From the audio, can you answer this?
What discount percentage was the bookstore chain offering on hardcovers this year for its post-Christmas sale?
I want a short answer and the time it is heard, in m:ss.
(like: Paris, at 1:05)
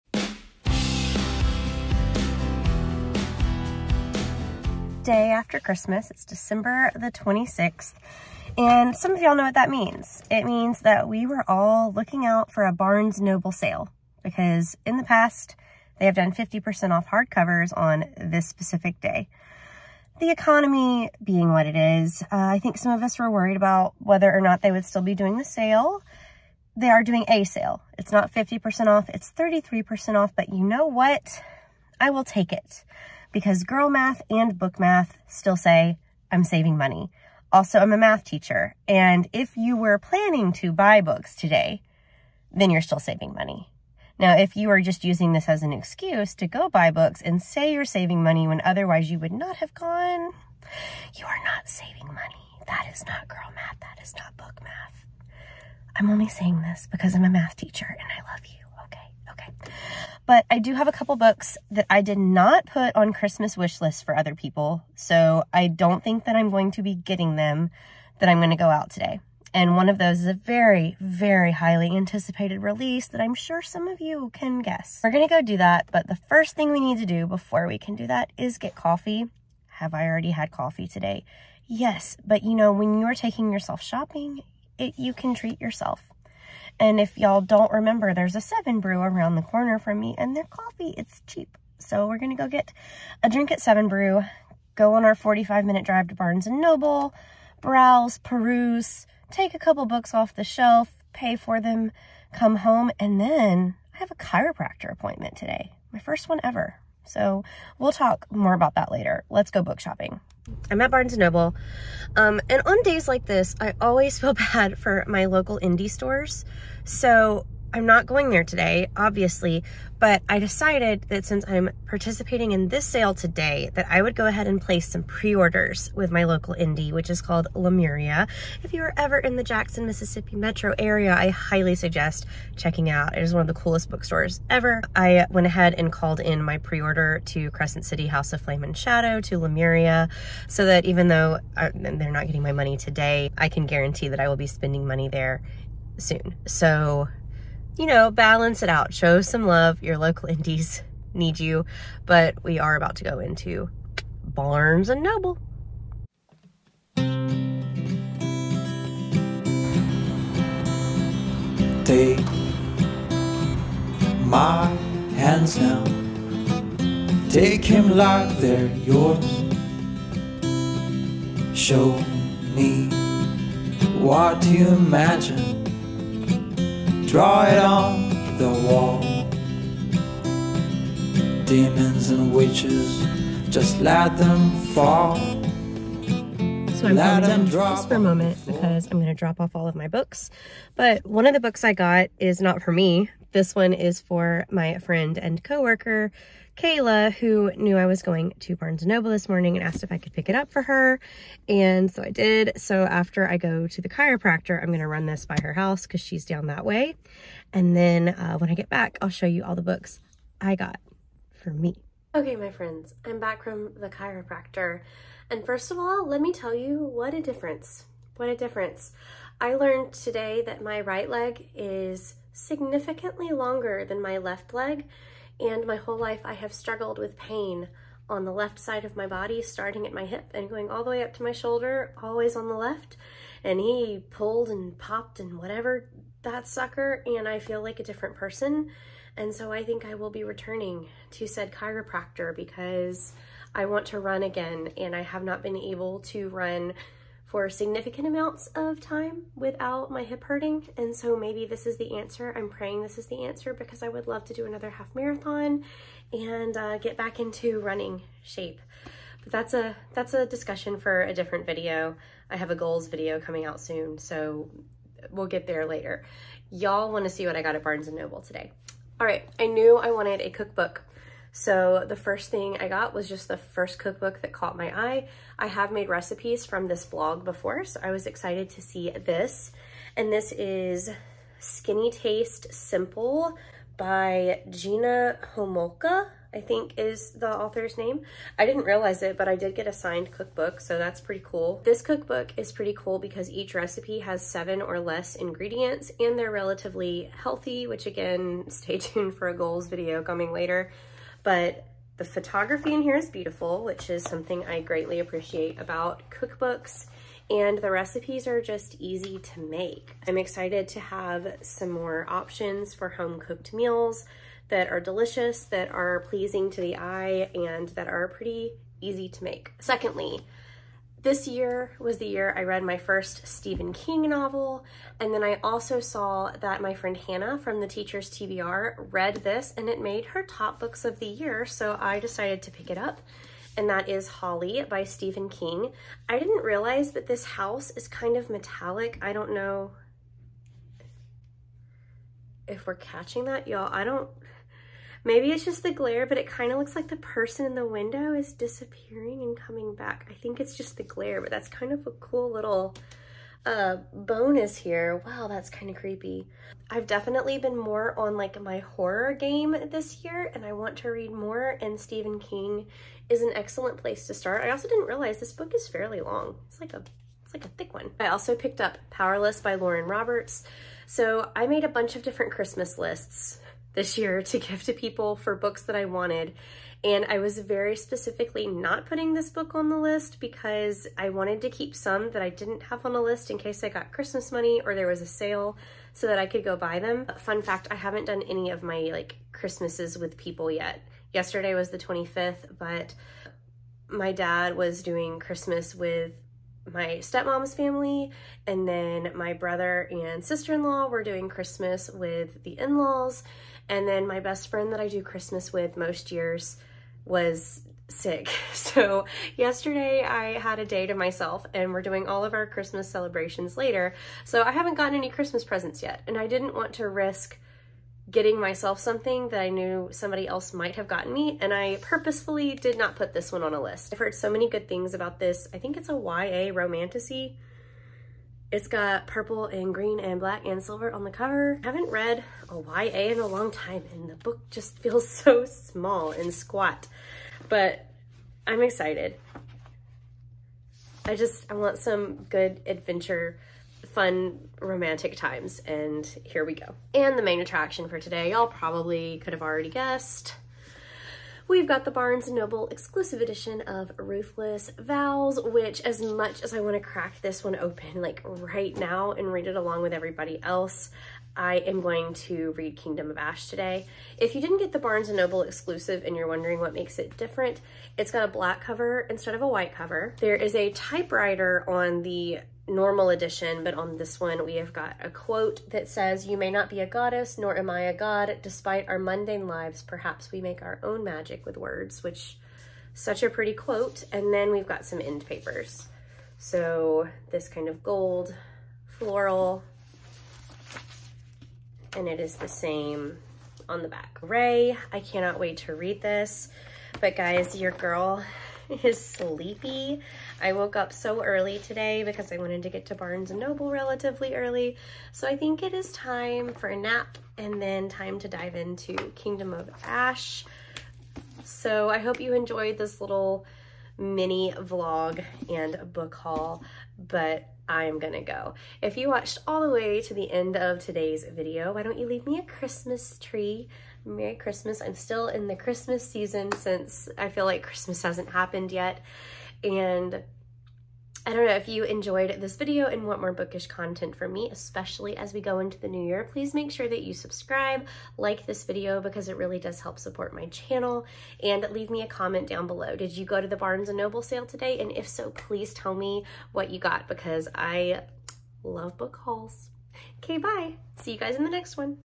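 33%, at 0:29.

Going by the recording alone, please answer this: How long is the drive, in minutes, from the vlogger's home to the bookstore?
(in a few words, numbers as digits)
45.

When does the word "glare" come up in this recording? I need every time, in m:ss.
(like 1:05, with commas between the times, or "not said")
5:45, 5:50.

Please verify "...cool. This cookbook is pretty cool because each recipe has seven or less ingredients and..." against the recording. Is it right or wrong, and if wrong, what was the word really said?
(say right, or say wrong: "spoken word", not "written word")
right.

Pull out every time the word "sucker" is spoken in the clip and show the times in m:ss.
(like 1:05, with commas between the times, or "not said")
3:56.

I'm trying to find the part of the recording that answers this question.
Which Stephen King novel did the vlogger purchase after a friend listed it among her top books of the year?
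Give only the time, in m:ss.
5:34.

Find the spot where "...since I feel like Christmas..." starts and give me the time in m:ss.
8:46.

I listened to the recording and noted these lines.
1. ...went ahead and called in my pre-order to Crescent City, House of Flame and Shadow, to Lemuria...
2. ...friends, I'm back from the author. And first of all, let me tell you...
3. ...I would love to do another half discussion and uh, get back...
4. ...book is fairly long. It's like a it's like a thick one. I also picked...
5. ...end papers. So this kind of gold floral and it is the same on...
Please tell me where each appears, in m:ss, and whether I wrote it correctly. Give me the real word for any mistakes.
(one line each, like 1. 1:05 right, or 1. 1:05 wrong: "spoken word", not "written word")
1. 2:15 right
2. 3:32 wrong: "chiropractor", not "author"
3. 4:13 wrong: "marathon", not "discussion"
4. 6:05 right
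5. 8:04 right.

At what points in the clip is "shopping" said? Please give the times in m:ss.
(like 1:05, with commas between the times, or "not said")
1:23, 1:49.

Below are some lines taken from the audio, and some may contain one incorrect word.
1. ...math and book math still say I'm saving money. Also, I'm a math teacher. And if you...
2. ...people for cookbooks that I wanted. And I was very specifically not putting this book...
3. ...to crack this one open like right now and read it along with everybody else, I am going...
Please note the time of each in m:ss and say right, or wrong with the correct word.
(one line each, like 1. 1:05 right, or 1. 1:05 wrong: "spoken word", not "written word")
1. 0:33 right
2. 6:14 wrong: "books", not "cookbooks"
3. 7:36 right.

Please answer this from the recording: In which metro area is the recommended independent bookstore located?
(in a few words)
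Jackson, Mississippi.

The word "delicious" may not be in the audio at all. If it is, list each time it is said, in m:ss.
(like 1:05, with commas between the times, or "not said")
5:14.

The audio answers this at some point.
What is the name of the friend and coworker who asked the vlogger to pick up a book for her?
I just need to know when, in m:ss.
3:16.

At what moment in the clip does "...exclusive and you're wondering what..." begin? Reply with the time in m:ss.
7:45.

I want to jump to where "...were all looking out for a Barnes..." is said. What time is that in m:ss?
0:11.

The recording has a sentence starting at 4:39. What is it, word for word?
And this is Skinny Taste Simple by Gina Homolka, I think is the author's name.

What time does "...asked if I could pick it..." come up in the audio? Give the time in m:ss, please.
3:19.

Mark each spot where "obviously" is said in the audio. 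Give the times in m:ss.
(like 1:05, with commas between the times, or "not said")
1:58.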